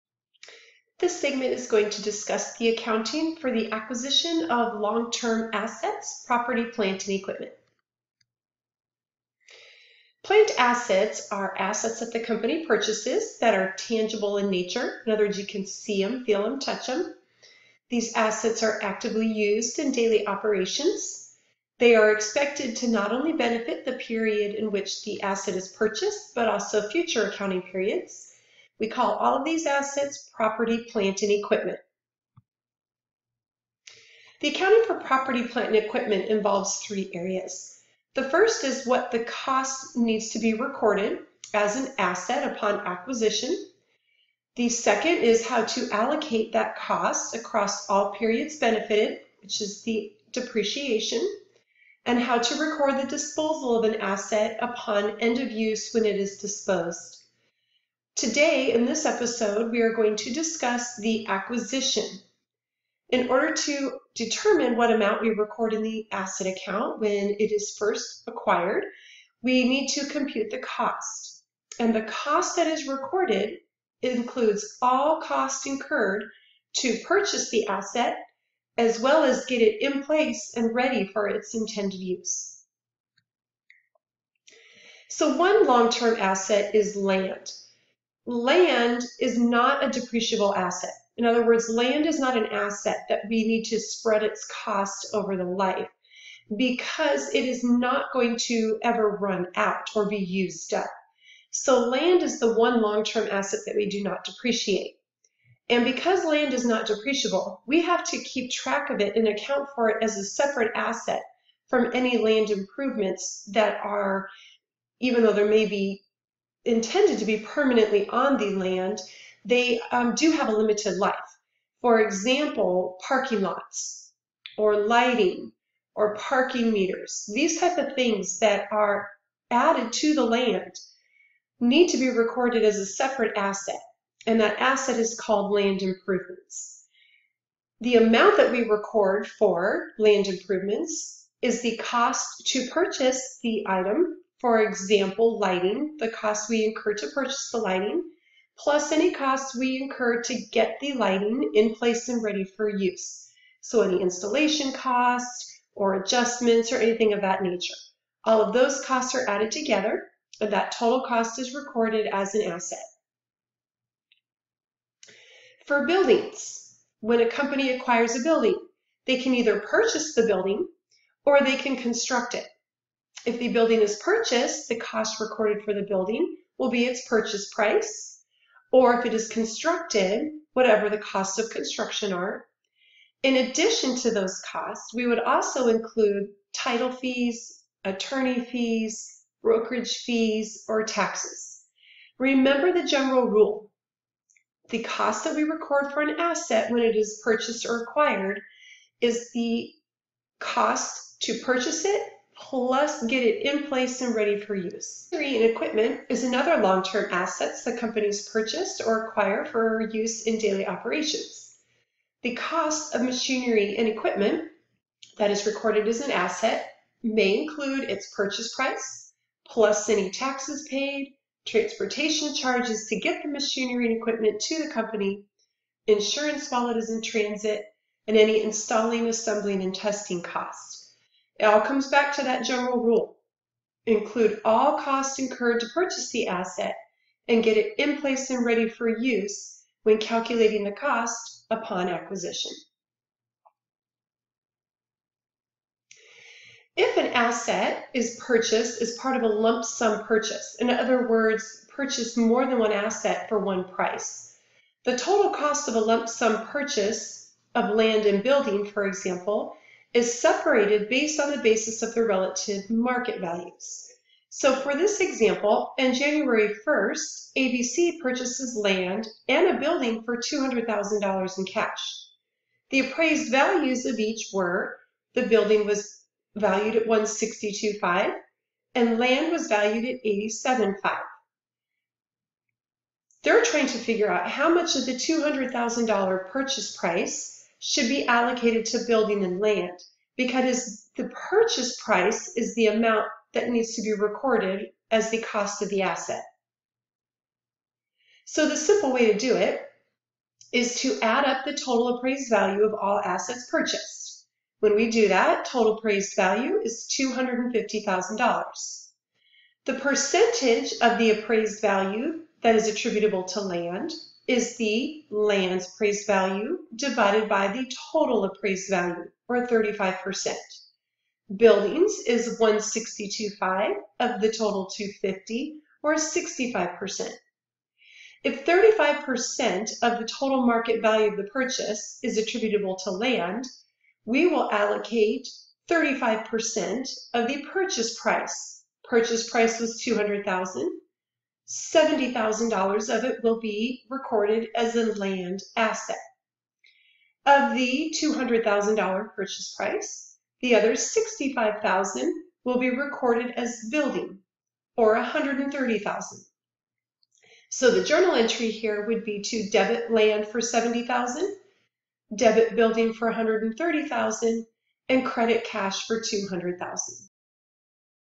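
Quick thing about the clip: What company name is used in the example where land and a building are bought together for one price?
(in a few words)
ABC.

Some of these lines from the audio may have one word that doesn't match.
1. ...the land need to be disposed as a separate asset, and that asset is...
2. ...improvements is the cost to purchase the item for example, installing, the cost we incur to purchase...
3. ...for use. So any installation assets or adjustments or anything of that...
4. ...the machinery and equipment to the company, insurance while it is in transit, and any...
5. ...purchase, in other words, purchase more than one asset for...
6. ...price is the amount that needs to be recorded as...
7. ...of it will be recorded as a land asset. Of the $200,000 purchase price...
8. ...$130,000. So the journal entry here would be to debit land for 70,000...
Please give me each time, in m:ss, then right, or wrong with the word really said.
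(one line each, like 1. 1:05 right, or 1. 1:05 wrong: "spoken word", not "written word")
1. 2:10 wrong: "recorded", not "disposed"
2. 2:20 wrong: "lighting", not "installing"
3. 2:32 wrong: "costs", not "assets"
4. 3:43 right
5. 4:10 right
6. 4:51 right
7. 5:42 right
8. 5:54 right.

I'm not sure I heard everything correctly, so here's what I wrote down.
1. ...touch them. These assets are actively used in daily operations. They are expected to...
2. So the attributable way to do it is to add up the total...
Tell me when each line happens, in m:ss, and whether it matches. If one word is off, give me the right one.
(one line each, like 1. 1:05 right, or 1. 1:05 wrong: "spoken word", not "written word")
1. 0:16 right
2. 4:58 wrong: "simple", not "attributable".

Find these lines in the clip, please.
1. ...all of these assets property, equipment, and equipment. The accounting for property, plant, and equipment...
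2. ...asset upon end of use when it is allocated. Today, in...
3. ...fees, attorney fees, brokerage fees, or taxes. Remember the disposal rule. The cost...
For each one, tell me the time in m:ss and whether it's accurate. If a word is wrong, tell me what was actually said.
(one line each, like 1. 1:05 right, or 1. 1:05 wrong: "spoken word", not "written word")
1. 0:29 wrong: "plant", not "equipment"
2. 0:54 wrong: "disposed", not "allocated"
3. 3:06 wrong: "general", not "disposal".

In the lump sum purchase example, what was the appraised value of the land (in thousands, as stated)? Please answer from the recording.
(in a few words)
87.5.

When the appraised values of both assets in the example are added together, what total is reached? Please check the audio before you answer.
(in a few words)
$250,000.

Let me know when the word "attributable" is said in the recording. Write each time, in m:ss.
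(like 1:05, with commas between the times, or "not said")
5:12, 5:32.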